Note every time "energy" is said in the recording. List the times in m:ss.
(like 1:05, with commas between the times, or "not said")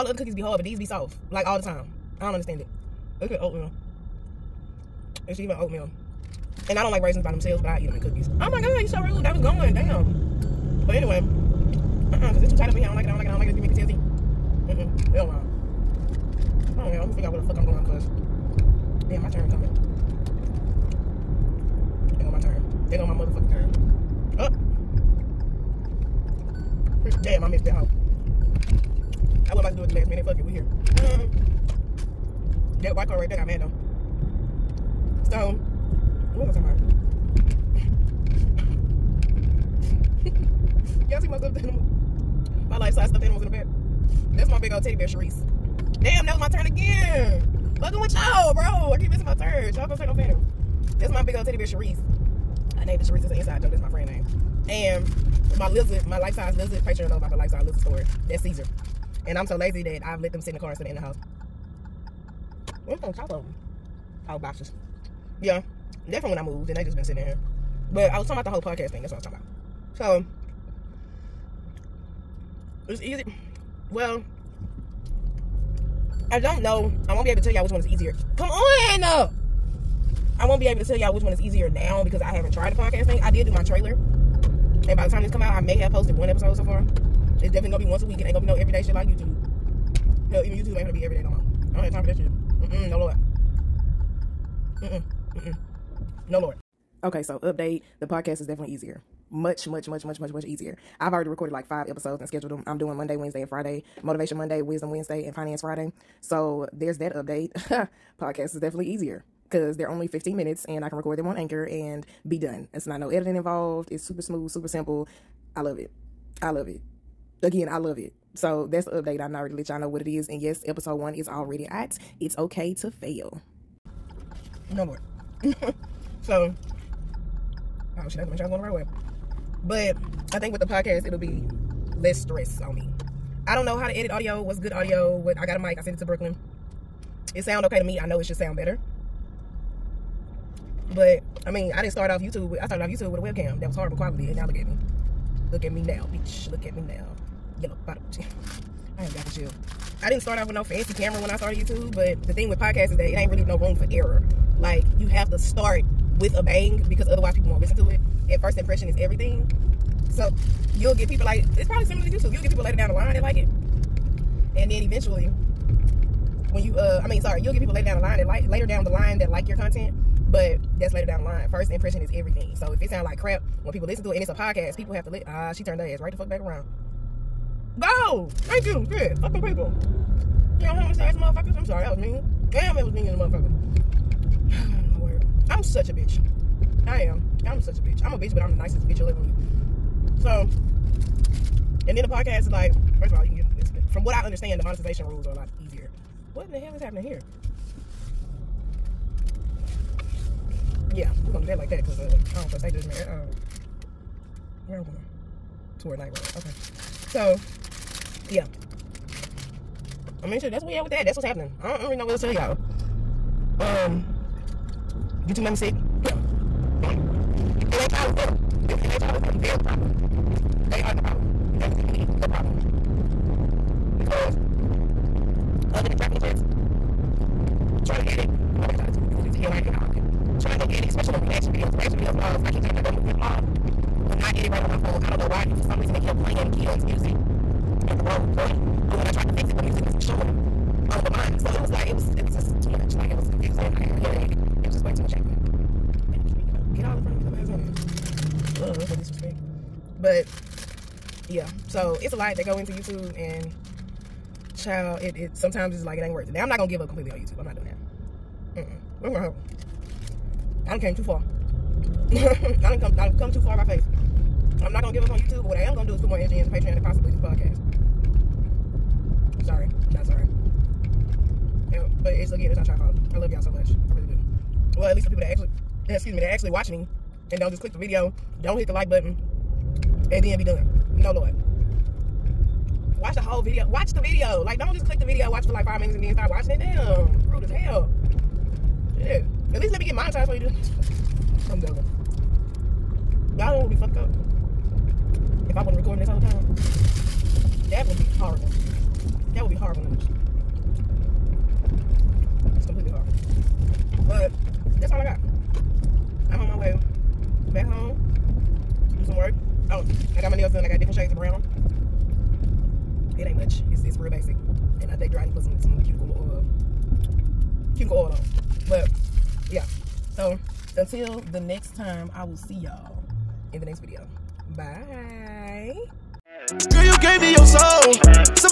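4:26.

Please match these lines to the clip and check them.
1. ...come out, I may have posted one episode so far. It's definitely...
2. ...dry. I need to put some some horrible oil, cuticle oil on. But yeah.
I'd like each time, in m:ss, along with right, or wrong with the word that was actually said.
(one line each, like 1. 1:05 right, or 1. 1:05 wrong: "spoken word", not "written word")
1. 1:25 right
2. 5:15 wrong: "cuticle", not "horrible".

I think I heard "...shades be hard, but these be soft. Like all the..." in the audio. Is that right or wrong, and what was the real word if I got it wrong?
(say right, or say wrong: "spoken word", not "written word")
wrong: "cookies", not "shades".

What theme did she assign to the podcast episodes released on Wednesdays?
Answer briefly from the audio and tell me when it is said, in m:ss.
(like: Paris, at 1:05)
Wisdom Wednesday, at 1:44.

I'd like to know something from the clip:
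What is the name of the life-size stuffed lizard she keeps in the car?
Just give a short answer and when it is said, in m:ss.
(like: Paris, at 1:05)
Caesar, at 0:58.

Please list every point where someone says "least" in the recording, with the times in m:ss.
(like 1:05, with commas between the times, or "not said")
4:34, 4:49.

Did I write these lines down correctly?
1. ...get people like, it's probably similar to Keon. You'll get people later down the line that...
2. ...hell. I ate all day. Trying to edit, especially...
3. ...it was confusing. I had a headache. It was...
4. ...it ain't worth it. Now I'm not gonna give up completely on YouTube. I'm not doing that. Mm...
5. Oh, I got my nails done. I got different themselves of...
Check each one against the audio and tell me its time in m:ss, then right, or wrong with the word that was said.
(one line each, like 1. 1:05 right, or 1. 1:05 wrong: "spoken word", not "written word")
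1. 2:40 wrong: "YouTube", not "Keon"
2. 3:49 right
3. 4:03 right
4. 4:15 right
5. 5:09 wrong: "shades", not "themselves".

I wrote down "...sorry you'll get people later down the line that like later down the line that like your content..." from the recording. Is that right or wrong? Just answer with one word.
right.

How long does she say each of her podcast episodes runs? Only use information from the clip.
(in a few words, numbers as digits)
15 minutes.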